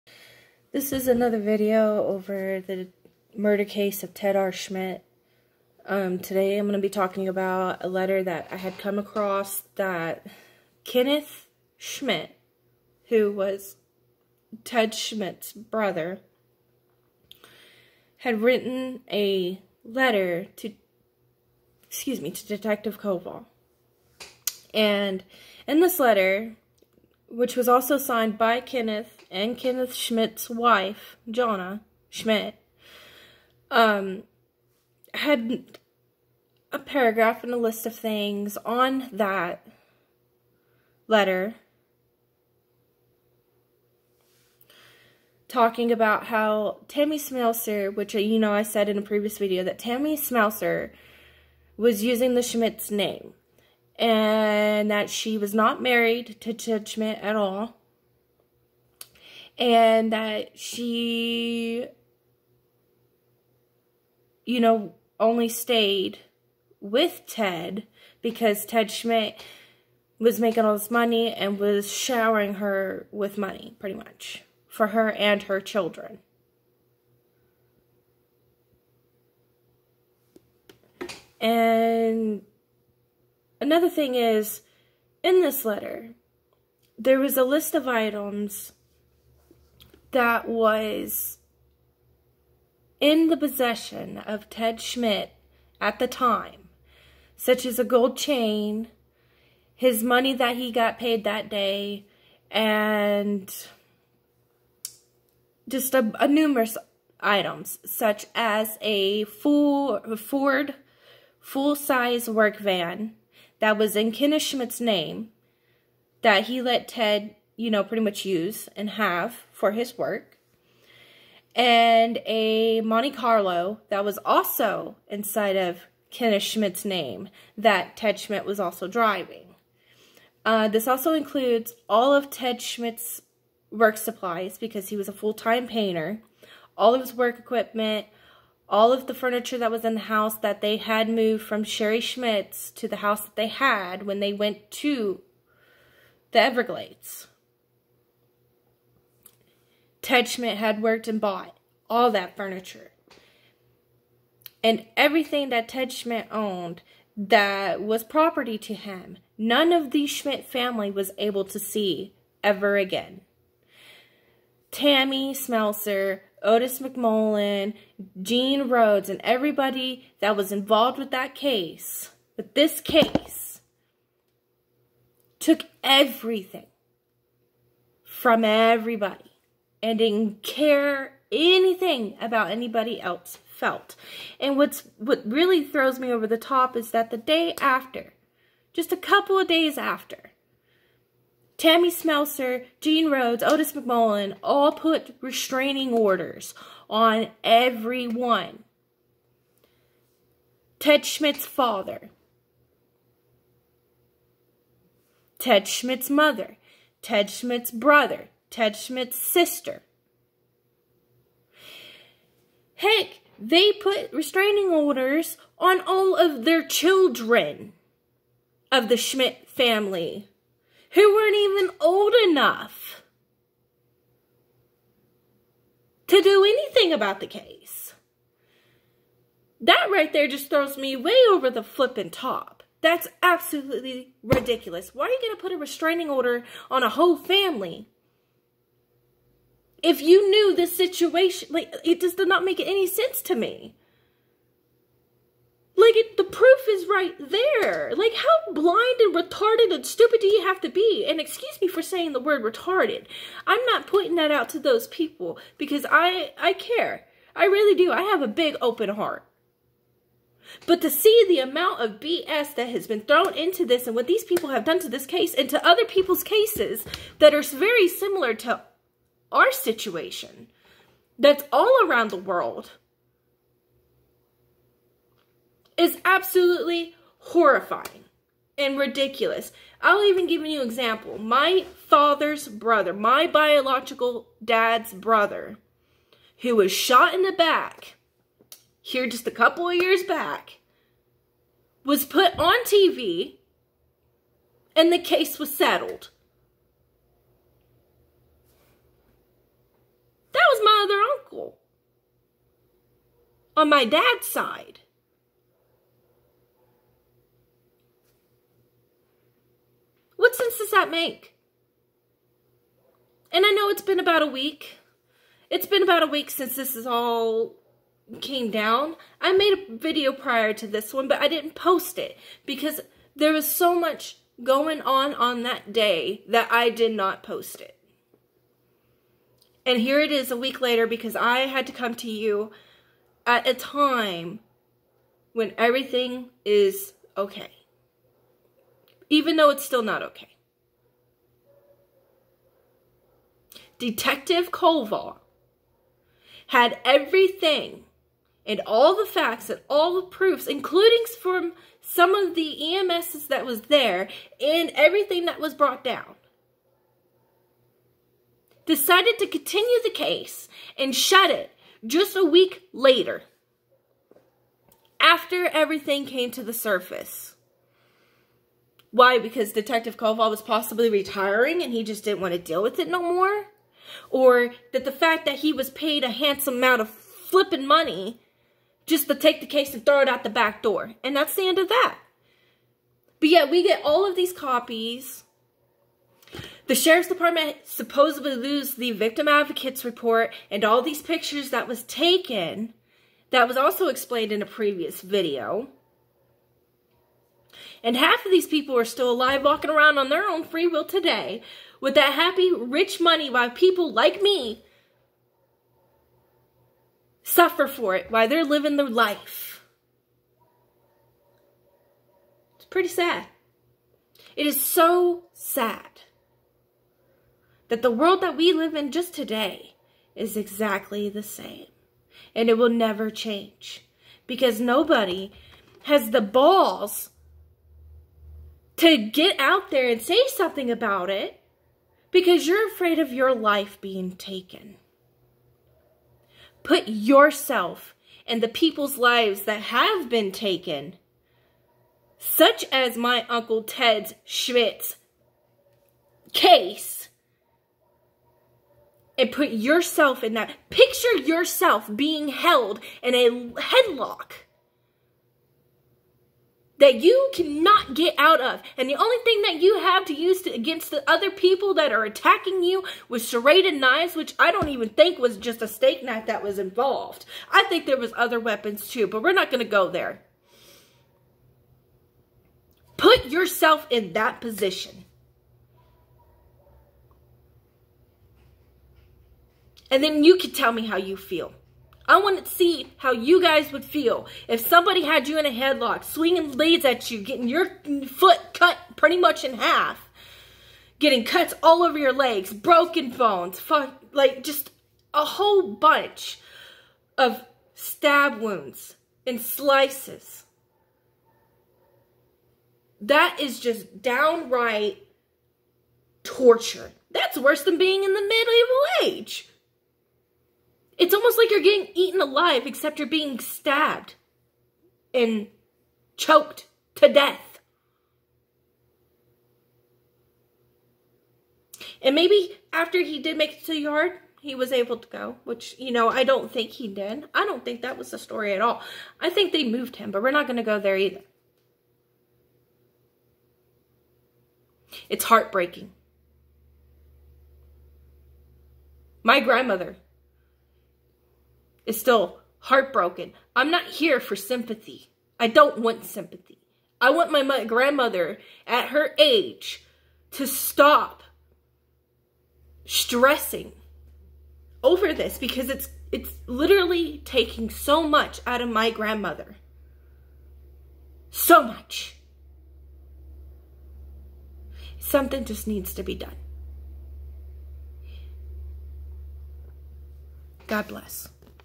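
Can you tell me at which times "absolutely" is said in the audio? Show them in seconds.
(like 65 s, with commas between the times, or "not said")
233 s, 276 s.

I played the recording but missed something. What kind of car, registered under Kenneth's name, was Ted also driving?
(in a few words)
Monte Carlo.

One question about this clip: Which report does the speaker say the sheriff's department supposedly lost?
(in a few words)
Victim advocates report.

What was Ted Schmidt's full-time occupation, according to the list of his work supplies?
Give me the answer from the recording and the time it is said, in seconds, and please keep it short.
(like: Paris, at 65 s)
Painter, at 135 s.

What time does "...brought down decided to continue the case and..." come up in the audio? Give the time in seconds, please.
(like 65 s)
355 s.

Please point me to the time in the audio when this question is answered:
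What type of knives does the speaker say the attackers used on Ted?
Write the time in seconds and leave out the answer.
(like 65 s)
463 s.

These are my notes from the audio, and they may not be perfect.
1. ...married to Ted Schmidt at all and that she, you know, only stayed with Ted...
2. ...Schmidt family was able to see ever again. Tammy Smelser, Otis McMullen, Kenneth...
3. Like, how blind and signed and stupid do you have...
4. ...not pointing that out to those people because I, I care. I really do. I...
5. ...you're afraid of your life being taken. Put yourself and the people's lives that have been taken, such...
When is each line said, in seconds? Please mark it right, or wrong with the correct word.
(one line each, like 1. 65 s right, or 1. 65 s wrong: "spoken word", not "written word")
1. 55 s right
2. 160 s wrong: "Gene", not "Kenneth"
3. 247 s wrong: "retarded", not "signed"
4. 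253 s right
5. 432 s right.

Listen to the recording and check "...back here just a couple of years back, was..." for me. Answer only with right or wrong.
right.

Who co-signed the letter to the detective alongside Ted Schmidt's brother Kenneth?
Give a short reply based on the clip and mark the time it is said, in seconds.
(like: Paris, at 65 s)
Jonna Schmidt, at 31 s.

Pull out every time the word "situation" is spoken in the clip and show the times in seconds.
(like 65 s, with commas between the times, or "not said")
240 s, 269 s.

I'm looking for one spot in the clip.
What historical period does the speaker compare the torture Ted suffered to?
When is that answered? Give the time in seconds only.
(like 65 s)
508 s.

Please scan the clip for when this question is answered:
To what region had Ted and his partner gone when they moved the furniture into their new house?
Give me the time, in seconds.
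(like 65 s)
146 s.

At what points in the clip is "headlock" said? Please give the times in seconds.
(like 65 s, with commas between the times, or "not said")
453 s, 485 s.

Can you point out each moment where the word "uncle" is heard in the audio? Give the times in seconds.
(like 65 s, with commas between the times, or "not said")
301 s, 443 s.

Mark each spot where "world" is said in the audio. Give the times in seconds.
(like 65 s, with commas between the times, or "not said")
272 s, 417 s.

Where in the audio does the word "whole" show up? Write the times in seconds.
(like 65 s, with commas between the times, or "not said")
236 s, 495 s.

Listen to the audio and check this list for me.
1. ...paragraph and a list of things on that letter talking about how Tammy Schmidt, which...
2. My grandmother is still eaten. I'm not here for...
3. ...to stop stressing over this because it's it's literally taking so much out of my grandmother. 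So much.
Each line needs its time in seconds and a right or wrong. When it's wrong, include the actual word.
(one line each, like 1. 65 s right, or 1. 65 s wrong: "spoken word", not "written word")
1. 36 s wrong: "Smelser", not "Schmidt"
2. 539 s wrong: "heartbroken", not "eaten"
3. 550 s right.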